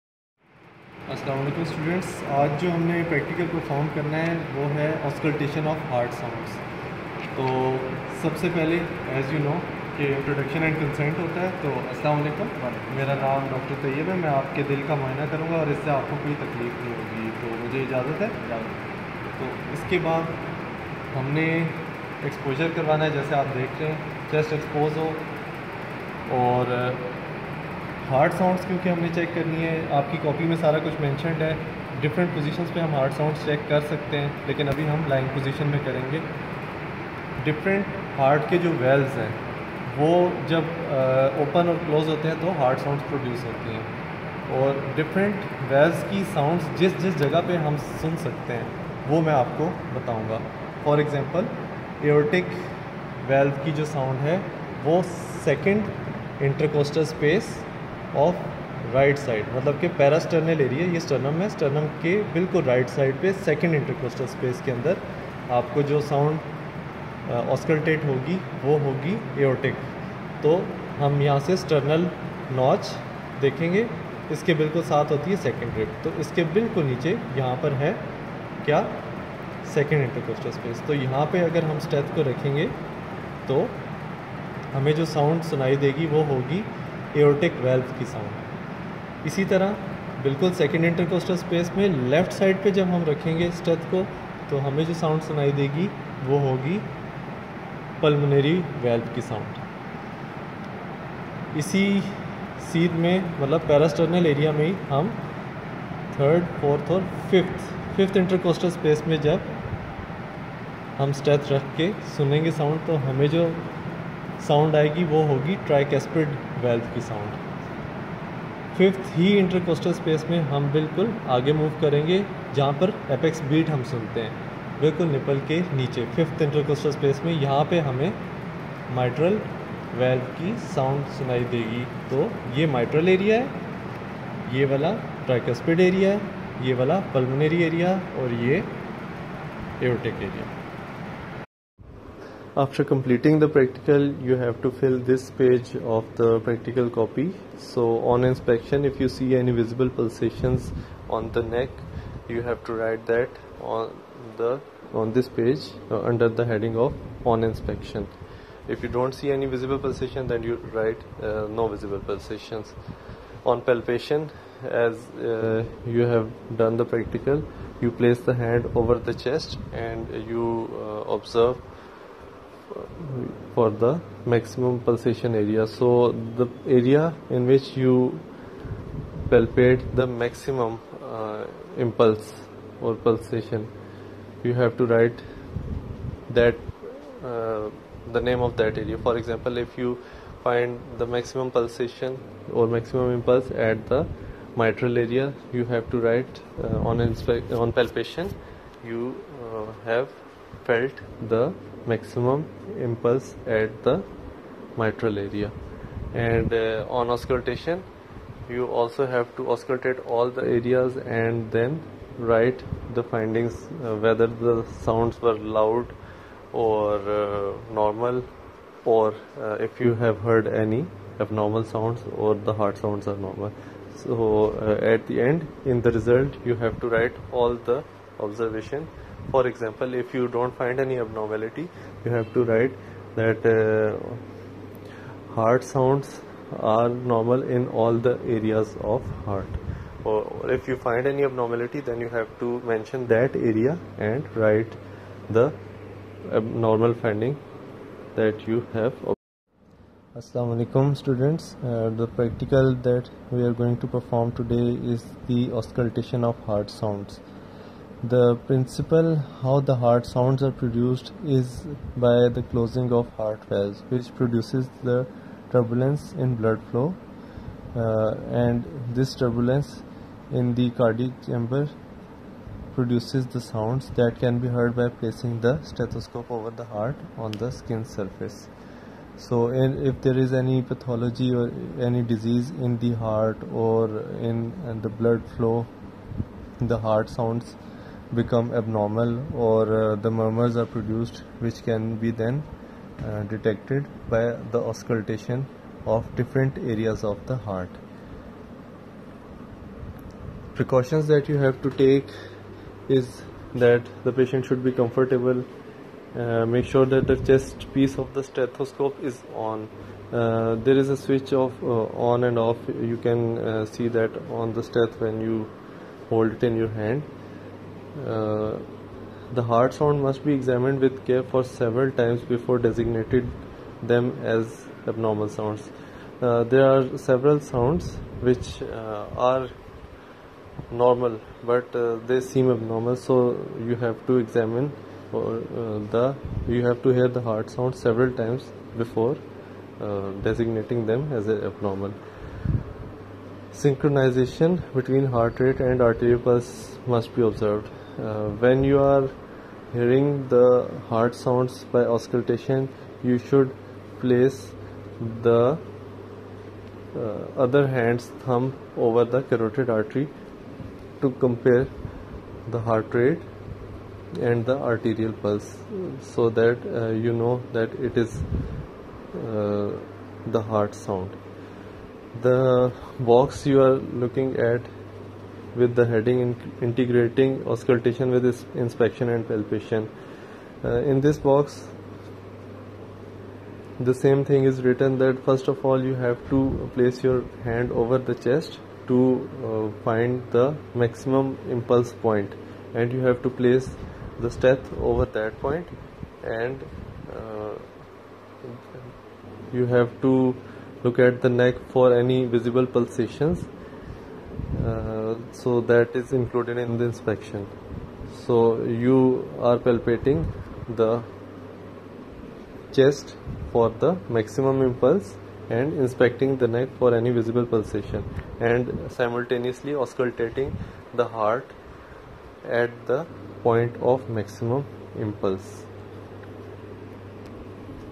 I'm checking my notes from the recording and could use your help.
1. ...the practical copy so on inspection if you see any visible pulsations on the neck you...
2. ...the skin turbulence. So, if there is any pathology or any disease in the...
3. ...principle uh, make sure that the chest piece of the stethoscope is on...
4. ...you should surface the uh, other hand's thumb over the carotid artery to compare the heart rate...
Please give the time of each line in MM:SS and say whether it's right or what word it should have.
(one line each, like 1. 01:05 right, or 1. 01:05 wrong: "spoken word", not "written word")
1. 02:26 right
2. 04:37 wrong: "surface", not "turbulence"
3. 05:04 wrong: "comfortable", not "principle"
4. 05:53 wrong: "place", not "surface".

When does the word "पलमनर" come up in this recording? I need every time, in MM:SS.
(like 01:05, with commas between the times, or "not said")
01:38, 02:17.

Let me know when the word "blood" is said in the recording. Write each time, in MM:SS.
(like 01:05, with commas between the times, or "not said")
04:26, 04:44.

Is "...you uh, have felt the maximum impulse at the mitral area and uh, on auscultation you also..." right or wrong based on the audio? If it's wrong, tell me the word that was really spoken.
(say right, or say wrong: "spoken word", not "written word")
right.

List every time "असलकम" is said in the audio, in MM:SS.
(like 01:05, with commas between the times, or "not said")
00:11.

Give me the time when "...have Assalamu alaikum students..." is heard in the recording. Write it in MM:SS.
04:08.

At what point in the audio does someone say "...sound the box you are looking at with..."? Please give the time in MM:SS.
06:10.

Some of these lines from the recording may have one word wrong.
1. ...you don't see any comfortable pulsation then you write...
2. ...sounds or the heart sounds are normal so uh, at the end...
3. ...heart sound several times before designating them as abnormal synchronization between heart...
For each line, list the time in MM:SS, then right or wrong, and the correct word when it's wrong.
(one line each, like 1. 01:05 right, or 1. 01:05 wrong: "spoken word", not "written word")
1. 02:38 wrong: "visible", not "comfortable"
2. 03:41 right
3. 05:37 right.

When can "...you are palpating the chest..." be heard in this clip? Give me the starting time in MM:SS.
06:48.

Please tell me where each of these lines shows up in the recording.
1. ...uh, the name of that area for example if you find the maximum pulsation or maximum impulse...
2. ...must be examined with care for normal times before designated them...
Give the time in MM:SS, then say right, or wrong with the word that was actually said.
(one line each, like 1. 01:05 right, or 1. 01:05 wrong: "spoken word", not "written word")
1. 03:07 right
2. 05:20 wrong: "several", not "normal".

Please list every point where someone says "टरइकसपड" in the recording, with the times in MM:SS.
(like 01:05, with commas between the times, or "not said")
01:55, 02:15.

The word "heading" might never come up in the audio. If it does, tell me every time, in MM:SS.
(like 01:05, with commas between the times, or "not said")
02:36, 06:15.